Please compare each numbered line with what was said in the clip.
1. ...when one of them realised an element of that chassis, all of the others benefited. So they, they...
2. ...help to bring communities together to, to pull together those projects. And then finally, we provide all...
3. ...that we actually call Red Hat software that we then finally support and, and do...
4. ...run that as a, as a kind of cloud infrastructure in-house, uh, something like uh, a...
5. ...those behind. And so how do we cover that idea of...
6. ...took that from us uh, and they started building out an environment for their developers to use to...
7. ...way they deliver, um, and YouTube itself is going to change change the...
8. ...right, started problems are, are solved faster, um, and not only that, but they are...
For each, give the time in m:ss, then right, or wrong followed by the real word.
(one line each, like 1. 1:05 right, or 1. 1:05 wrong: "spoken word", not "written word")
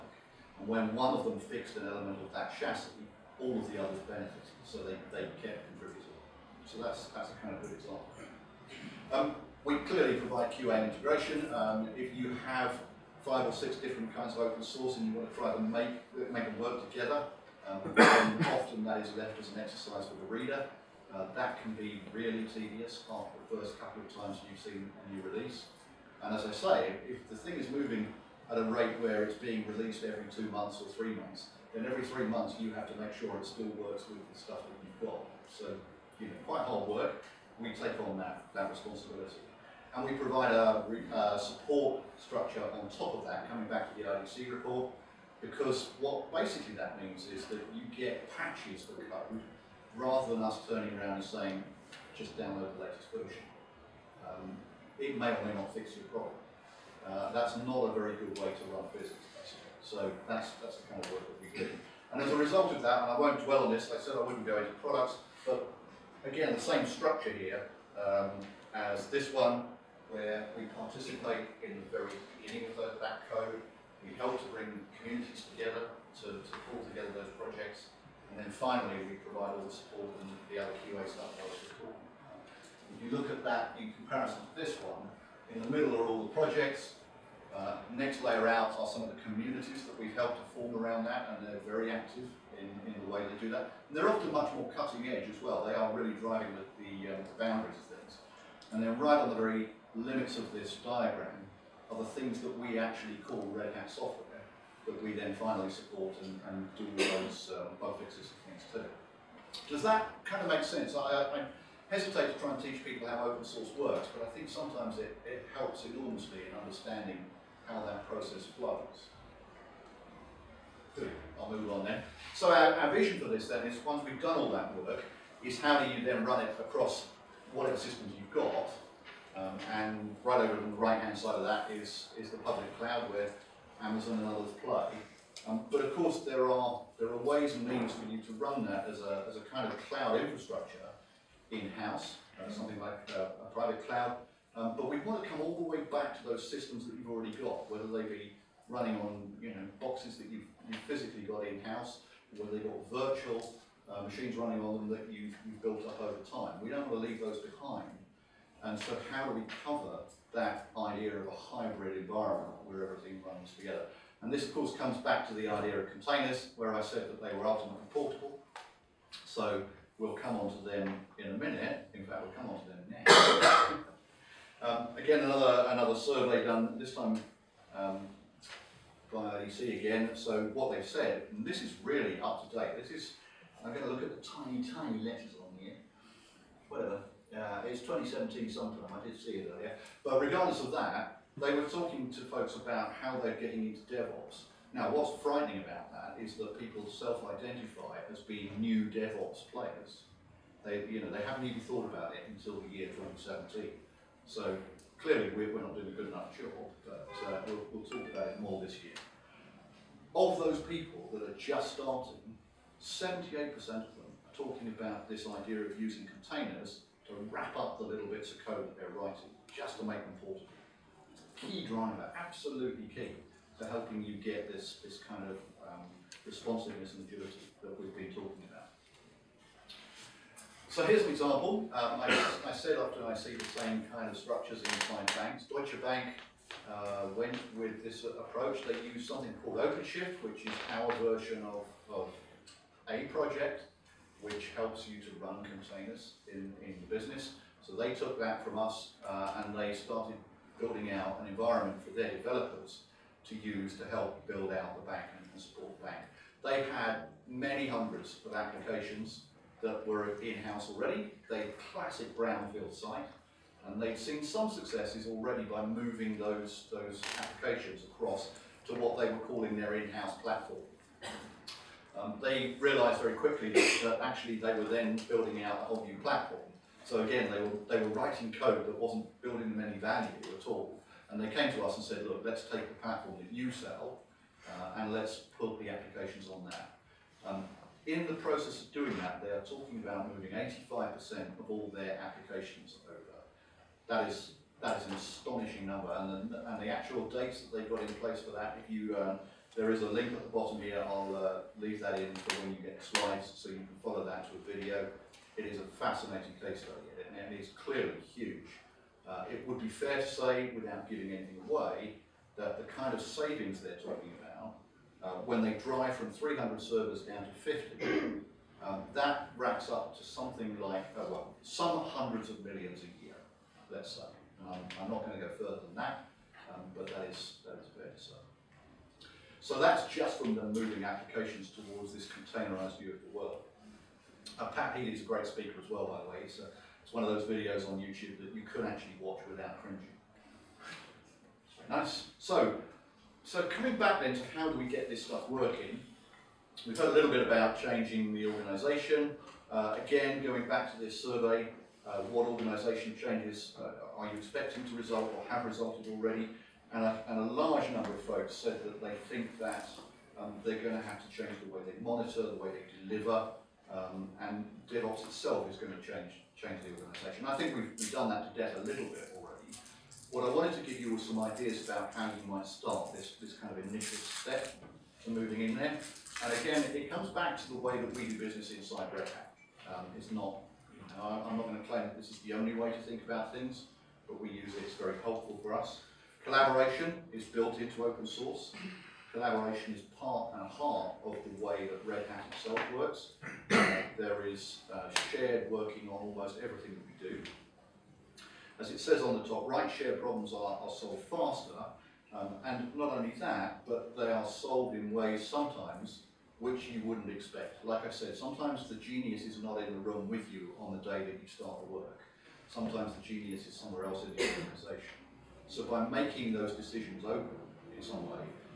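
1. 0:00 wrong: "fixed", not "realised"
2. 1:14 right
3. 1:42 right
4. 2:18 right
5. 2:37 right
6. 4:07 right
7. 6:02 wrong: "DevOps", not "YouTube"
8. 6:39 wrong: "shared", not "started".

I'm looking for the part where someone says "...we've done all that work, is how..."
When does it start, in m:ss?
2:04.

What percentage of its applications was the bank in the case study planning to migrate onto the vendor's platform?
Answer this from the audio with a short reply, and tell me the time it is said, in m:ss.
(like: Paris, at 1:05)
85%, at 4:50.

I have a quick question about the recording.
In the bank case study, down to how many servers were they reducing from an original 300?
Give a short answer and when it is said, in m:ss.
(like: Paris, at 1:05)
50, at 5:17.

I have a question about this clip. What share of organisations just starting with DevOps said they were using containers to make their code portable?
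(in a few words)
78%.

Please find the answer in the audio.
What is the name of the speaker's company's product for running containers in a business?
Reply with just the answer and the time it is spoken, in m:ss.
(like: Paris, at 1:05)
OpenShift, at 3:59.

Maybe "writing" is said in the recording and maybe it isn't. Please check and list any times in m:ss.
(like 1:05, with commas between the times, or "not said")
3:39, 4:37.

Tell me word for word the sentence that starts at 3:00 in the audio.
So what they've said, and this is really up to date.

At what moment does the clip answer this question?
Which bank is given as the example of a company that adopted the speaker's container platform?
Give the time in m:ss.
3:55.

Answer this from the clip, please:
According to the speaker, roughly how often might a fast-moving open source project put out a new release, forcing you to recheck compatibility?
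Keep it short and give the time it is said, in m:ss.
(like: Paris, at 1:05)
every 2 months, at 0:30.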